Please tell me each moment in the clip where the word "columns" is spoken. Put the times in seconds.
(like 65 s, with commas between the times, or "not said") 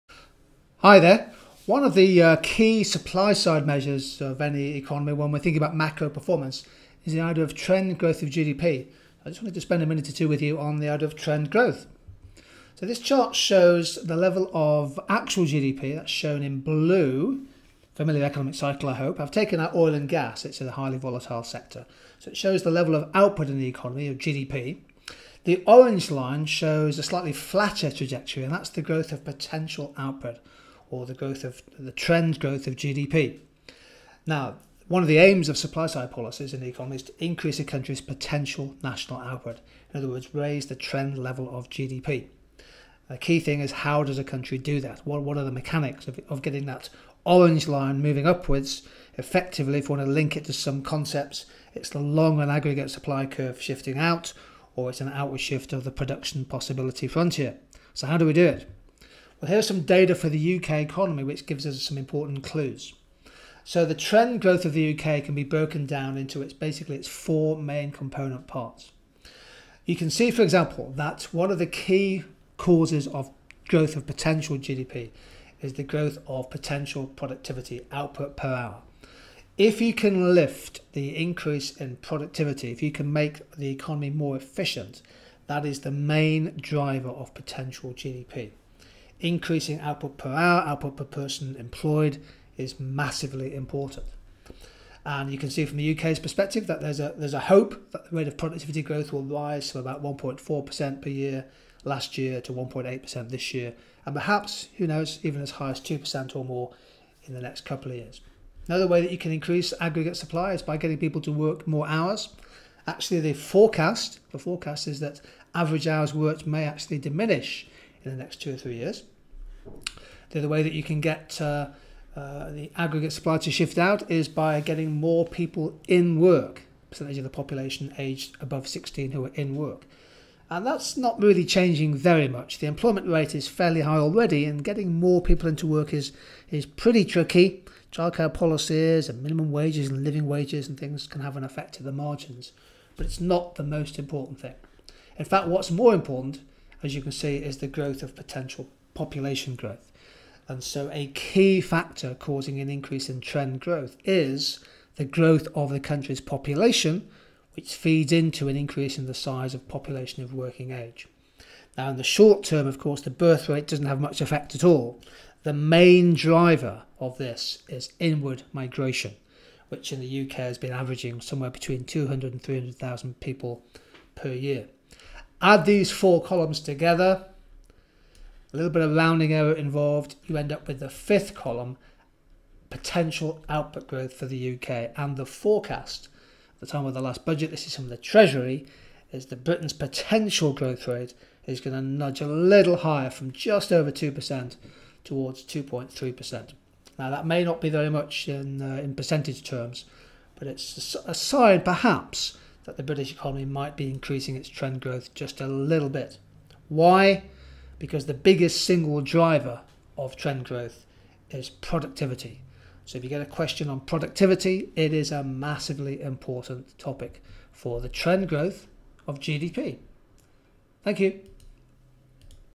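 176 s, 181 s.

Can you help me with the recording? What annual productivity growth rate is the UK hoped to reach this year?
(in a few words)
1.8%.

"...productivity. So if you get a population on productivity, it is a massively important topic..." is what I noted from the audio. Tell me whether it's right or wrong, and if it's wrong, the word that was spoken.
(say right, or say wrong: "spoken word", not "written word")
wrong: "question", not "population".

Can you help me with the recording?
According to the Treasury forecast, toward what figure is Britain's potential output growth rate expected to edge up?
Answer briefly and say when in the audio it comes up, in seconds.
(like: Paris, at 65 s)
2.3%, at 195 s.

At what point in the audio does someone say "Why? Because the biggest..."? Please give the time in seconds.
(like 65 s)
206 s.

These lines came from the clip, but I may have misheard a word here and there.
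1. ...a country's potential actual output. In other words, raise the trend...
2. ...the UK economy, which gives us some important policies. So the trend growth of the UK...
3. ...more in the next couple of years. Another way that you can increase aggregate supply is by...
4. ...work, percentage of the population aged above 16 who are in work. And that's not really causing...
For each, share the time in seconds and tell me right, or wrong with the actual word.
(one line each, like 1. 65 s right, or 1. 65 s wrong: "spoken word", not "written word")
1. 37 s wrong: "national", not "actual"
2. 60 s wrong: "clues", not "policies"
3. 106 s right
4. 126 s wrong: "changing", not "causing".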